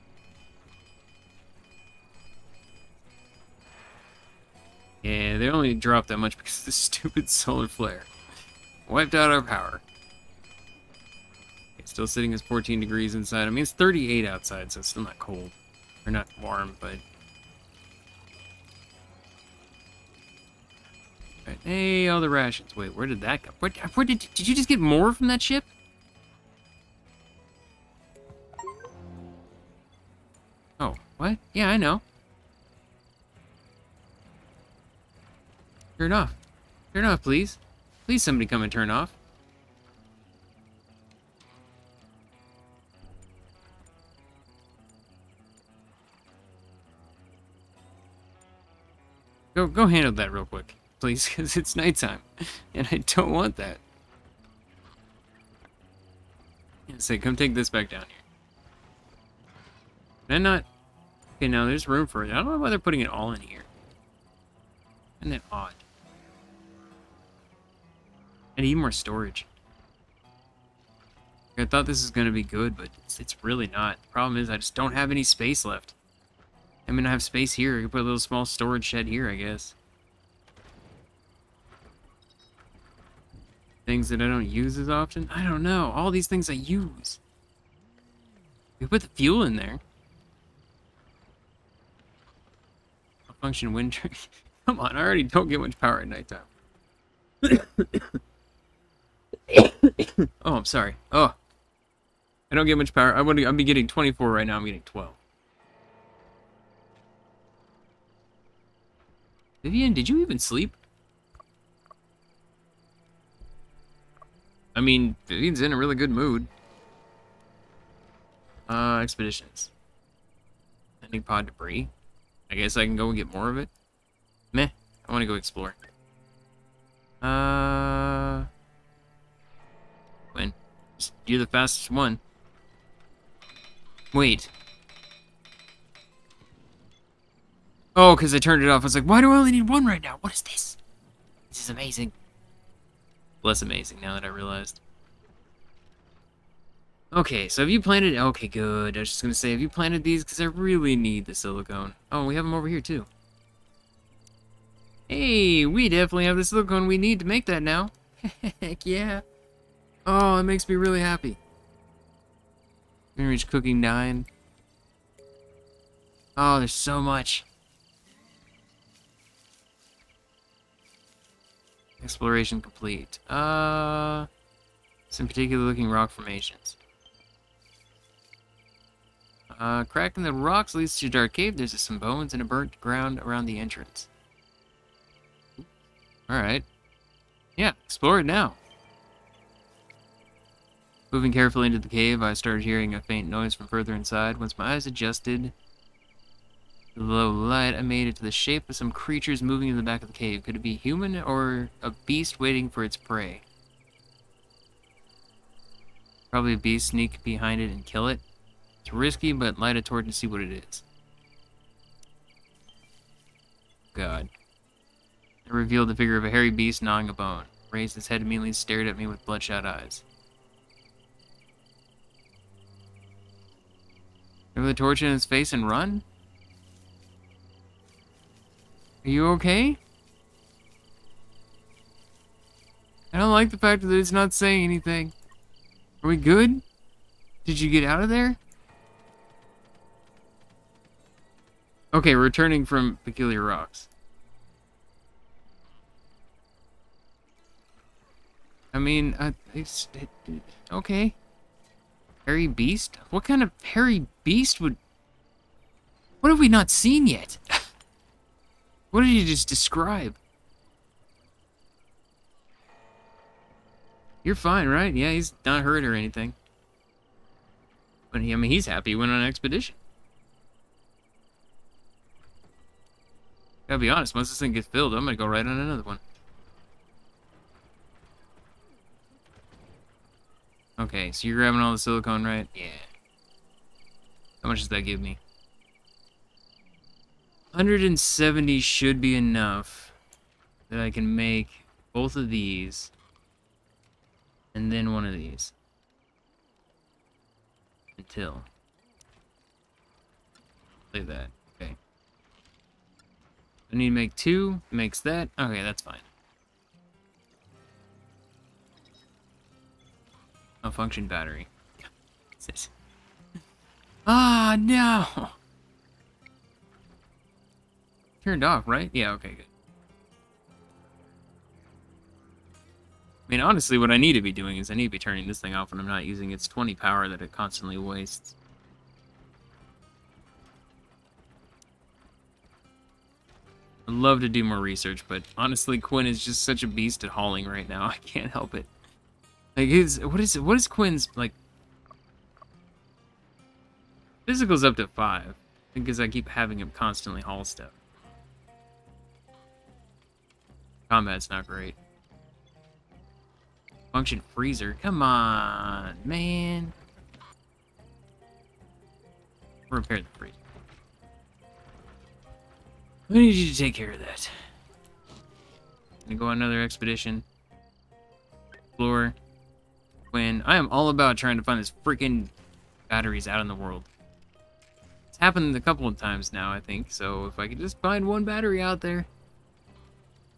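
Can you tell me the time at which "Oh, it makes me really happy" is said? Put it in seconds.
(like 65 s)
160 s.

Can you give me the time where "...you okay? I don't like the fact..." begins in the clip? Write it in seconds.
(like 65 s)
229 s.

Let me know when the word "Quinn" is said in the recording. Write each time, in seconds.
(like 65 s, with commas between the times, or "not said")
335 s, 340 s.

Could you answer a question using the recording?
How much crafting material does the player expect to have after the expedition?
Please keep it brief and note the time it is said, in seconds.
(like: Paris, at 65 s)
170, at 287 s.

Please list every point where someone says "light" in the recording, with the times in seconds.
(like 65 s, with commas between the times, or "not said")
197 s, 209 s.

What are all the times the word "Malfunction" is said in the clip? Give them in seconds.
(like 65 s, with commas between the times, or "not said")
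310 s.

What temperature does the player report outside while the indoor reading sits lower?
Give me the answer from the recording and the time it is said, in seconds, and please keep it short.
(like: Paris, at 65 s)
38, at 13 s.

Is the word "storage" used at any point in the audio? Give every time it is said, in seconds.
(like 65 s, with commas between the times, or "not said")
68 s, 78 s.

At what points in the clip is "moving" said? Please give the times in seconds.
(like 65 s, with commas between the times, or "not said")
191 s, 199 s.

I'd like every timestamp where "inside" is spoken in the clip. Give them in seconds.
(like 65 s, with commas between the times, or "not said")
13 s, 193 s.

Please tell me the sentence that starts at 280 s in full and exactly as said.
Okay, so you're grabbing all the silicone, right?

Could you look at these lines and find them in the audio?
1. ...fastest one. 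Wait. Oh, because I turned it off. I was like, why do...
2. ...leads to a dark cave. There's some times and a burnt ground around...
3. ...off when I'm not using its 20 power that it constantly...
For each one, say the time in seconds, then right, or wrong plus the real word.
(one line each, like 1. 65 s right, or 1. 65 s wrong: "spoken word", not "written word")
1. 131 s right
2. 180 s wrong: "bones", not "times"
3. 325 s right.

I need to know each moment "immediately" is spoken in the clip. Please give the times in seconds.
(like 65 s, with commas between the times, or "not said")
218 s.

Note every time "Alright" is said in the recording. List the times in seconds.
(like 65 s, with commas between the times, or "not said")
186 s.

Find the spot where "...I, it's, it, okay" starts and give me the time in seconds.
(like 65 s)
249 s.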